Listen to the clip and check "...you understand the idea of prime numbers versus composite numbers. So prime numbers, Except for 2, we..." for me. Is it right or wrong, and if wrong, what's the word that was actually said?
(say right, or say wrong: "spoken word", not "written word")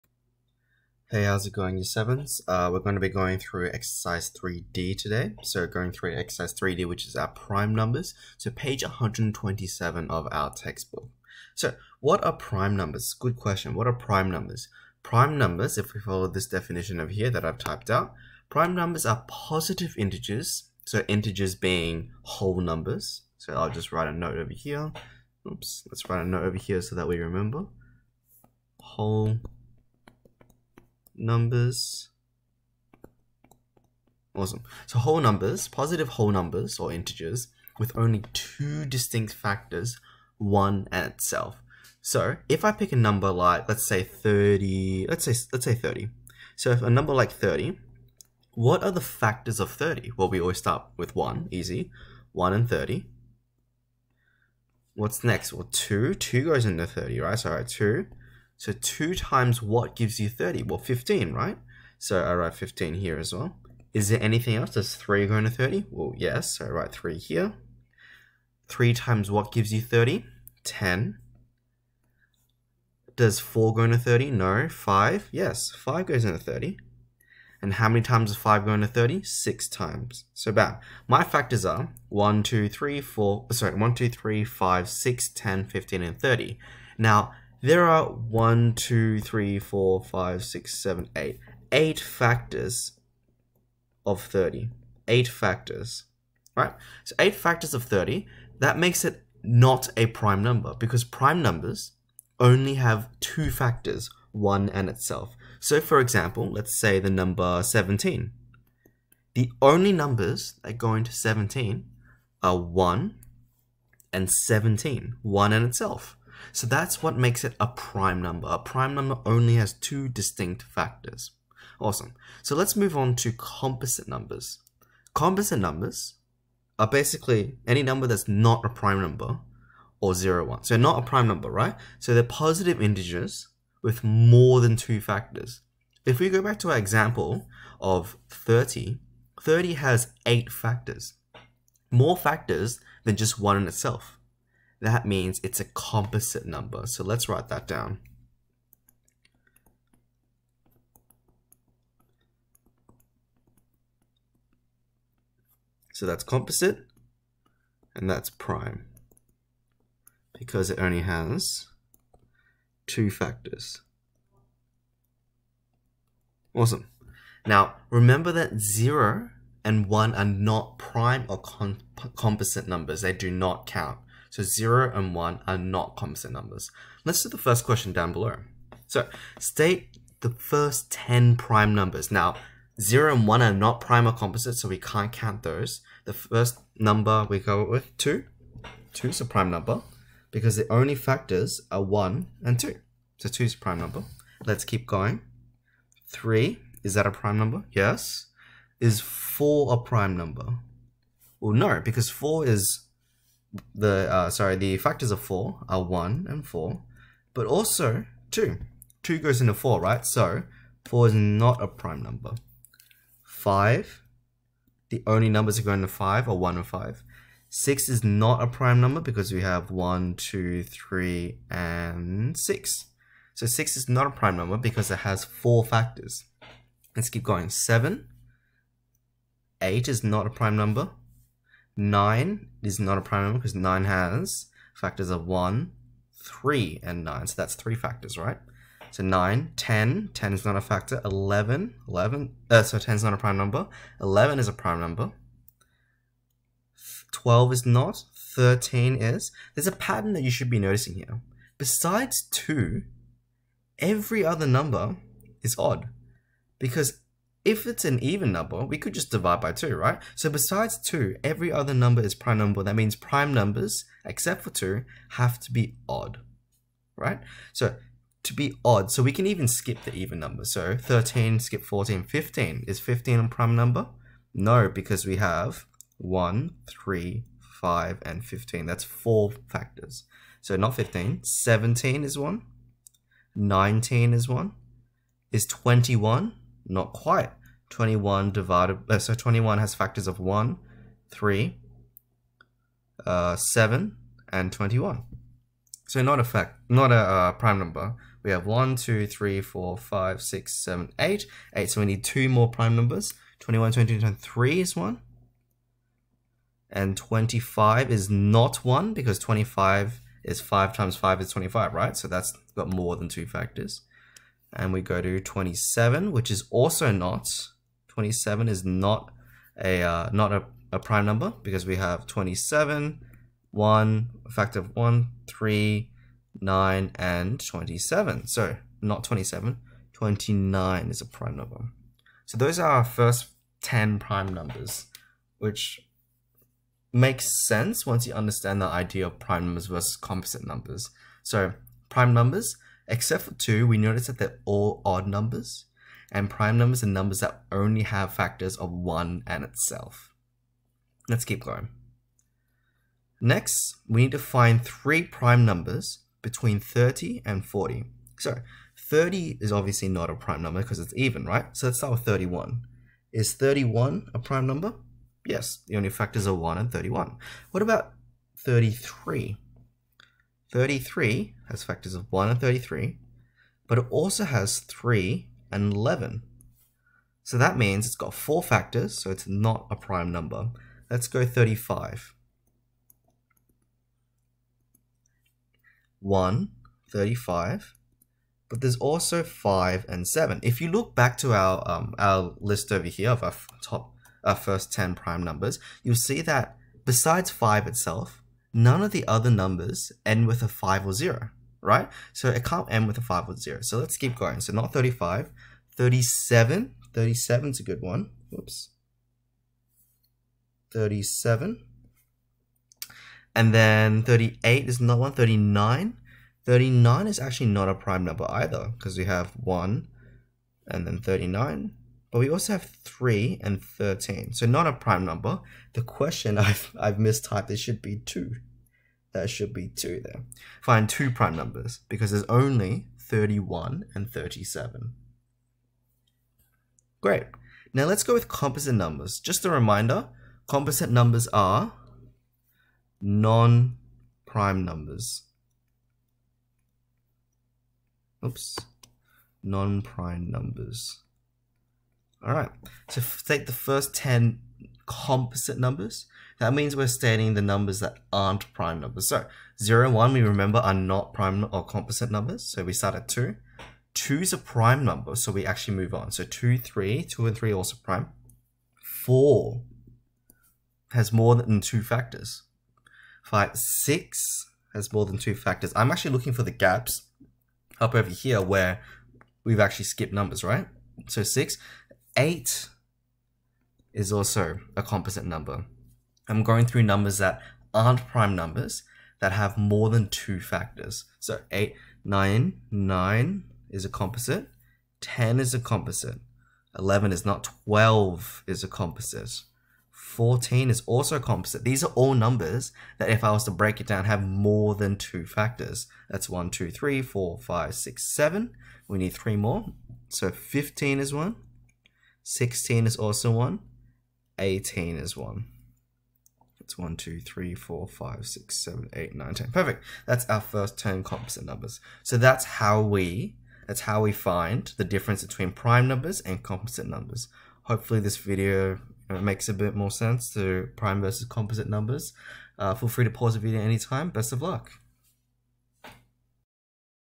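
right.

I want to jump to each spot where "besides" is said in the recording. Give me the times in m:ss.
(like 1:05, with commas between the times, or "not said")
4:11, 4:20, 6:36.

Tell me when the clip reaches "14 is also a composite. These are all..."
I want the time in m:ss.
8:19.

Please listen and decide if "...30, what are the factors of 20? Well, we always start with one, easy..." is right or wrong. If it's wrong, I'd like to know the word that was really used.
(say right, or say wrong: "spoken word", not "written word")
wrong: "30", not "20".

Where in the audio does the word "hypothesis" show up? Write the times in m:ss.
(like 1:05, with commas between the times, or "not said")
not said.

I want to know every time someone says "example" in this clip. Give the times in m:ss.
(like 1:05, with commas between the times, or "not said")
1:45, 2:16.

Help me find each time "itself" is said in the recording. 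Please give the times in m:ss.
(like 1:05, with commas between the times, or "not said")
0:41, 1:44, 1:55, 2:23, 5:49, 6:37.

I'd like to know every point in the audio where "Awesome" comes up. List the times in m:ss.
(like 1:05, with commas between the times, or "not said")
0:34, 2:01, 2:46.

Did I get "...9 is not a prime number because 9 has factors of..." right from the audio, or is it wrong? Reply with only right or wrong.
right.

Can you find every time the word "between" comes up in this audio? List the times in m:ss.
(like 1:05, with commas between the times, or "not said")
5:56, 8:45.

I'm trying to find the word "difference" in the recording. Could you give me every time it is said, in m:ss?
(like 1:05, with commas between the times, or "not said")
8:44.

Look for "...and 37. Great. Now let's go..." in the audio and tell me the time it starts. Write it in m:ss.
7:13.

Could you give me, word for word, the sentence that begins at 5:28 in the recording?
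So not 27, 29 is a prime number.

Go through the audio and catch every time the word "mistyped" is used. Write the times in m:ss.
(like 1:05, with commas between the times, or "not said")
7:06.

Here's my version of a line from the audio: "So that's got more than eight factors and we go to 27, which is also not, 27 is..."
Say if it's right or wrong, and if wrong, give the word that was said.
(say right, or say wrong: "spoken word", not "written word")
wrong: "two", not "eight".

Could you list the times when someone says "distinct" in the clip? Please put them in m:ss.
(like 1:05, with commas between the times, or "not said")
0:38, 2:00.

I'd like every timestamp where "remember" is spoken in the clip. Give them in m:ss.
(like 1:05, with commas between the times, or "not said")
0:27, 2:47, 7:40.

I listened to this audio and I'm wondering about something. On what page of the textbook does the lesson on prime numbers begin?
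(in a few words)
127.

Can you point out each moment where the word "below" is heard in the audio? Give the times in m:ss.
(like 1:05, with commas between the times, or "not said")
2:58.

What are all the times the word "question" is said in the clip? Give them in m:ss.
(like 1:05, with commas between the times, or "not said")
0:13, 2:57, 7:05.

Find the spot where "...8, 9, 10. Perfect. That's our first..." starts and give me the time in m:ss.
8:38.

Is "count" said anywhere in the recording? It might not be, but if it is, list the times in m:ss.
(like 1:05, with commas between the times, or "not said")
2:53, 3:05.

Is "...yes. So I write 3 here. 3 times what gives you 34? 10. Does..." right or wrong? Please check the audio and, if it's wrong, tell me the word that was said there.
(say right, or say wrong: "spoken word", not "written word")
wrong: "30", not "34".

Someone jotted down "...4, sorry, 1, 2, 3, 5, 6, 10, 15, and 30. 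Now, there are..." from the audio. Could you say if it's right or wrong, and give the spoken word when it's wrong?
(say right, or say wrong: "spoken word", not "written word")
right.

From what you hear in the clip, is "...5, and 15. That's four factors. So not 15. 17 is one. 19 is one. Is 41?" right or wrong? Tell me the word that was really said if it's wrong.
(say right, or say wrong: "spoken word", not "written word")
wrong: "21", not "41".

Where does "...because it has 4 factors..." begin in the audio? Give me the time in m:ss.
3:44.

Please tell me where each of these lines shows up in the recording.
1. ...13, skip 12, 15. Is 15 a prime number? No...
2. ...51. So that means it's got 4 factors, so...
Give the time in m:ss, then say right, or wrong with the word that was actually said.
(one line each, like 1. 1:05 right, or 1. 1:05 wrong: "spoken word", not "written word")
1. 4:30 wrong: "14", not "12"
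2. 6:15 wrong: "11", not "51".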